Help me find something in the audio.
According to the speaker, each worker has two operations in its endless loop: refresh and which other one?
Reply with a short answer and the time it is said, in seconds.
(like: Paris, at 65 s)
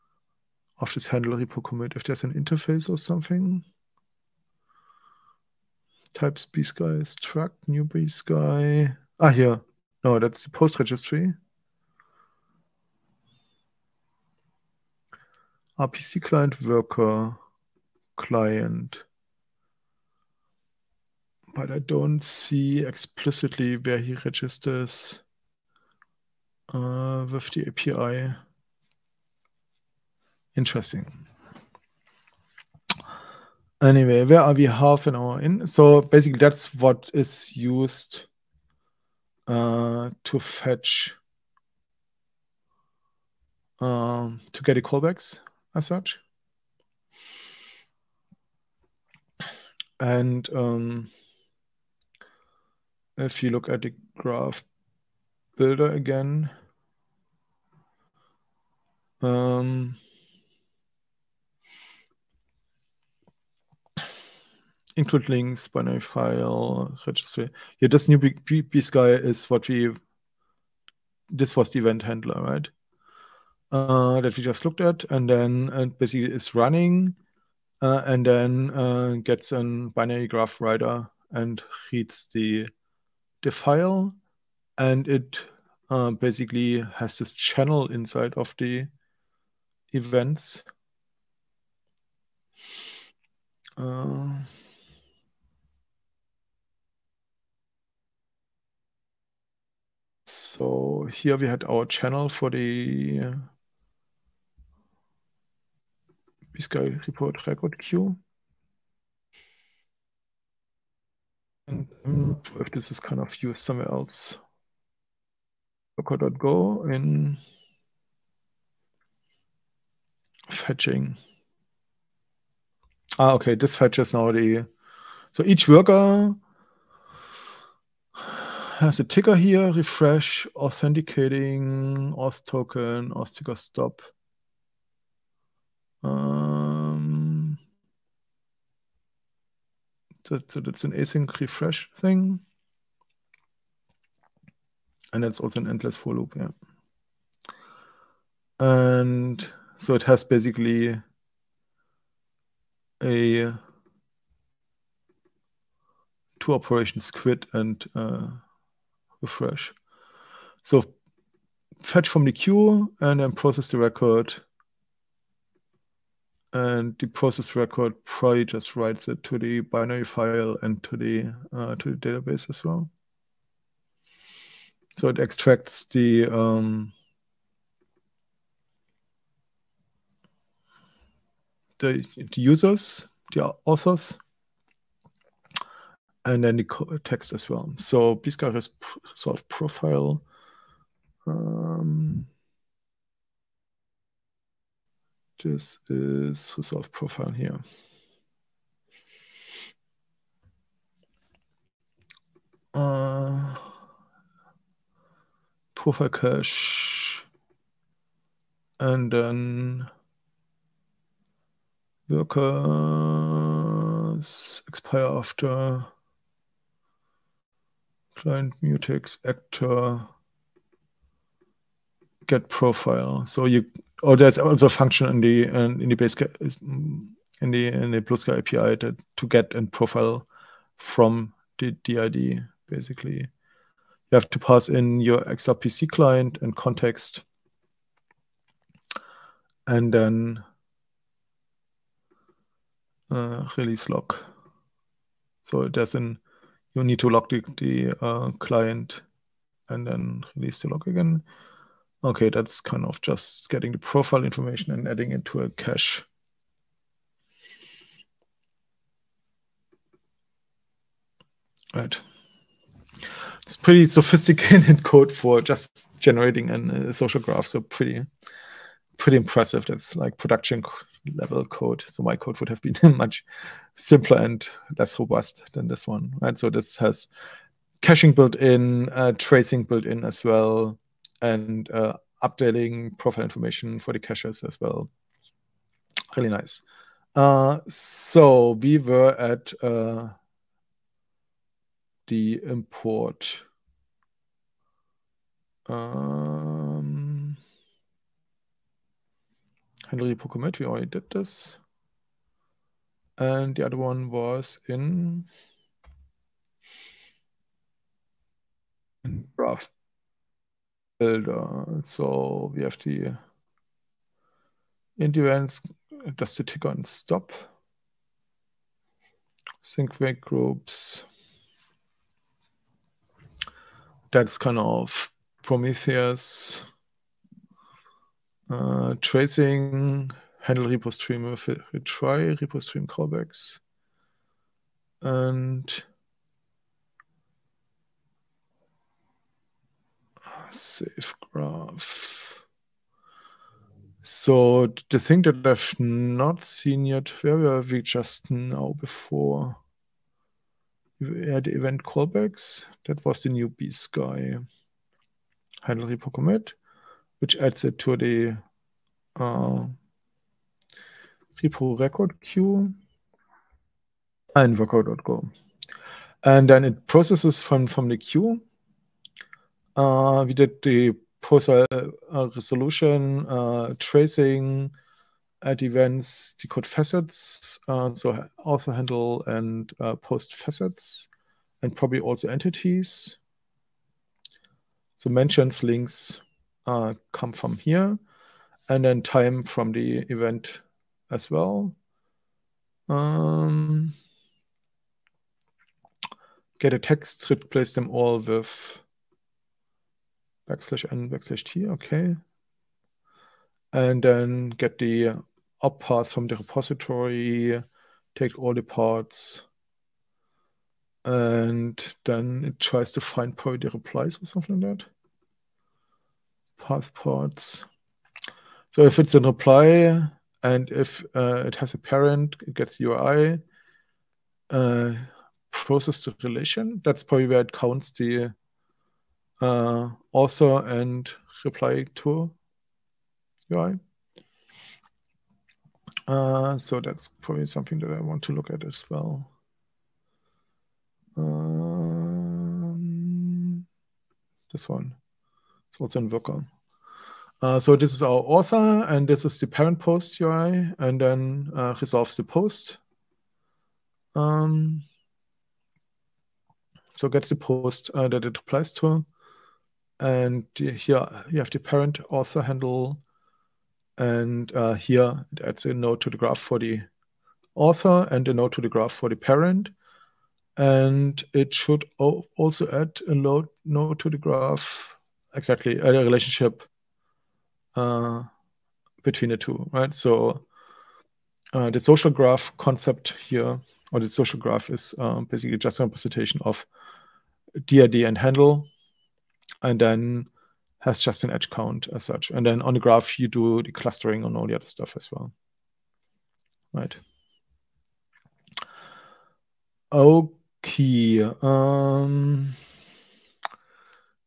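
quit, at 157 s.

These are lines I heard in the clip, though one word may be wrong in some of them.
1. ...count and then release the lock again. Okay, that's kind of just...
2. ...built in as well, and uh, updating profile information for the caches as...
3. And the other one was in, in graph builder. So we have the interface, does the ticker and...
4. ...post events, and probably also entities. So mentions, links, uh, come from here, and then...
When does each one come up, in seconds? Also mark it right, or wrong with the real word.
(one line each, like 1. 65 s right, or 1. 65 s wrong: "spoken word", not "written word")
1. 248 s wrong: "client", not "count"
2. 279 s right
3. 303 s wrong: "endurance", not "interface"
4. 379 s wrong: "facets", not "events".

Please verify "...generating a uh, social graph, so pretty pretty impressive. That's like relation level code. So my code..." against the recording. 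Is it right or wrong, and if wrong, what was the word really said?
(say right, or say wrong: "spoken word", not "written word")
wrong: "production", not "relation".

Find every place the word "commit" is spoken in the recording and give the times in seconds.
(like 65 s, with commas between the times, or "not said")
1 s, 356 s.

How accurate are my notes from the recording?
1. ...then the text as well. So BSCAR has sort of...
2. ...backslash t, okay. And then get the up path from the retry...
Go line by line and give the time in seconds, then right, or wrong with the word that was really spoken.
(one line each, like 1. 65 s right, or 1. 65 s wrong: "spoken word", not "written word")
1. 186 s right
2. 401 s wrong: "repository", not "retry".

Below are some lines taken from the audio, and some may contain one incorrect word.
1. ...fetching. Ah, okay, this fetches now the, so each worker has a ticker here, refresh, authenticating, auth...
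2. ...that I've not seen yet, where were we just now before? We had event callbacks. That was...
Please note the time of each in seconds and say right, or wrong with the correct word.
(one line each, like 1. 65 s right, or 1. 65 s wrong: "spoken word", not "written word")
1. 120 s right
2. 345 s right.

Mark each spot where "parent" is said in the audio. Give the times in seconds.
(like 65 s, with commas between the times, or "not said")
421 s, 449 s, 461 s, 469 s.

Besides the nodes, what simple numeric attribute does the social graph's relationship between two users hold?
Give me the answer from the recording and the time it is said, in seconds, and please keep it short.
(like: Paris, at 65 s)
edge count, at 491 s.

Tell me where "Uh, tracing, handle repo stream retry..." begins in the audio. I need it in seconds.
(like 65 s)
328 s.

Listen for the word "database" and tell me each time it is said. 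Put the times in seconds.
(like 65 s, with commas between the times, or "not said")
171 s.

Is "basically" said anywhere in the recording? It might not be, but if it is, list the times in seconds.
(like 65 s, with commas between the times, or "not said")
35 s, 75 s, 86 s, 150 s, 232 s, 485 s.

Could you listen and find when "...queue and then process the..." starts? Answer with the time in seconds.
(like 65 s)
162 s.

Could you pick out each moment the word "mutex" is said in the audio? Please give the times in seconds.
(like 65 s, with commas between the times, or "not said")
218 s.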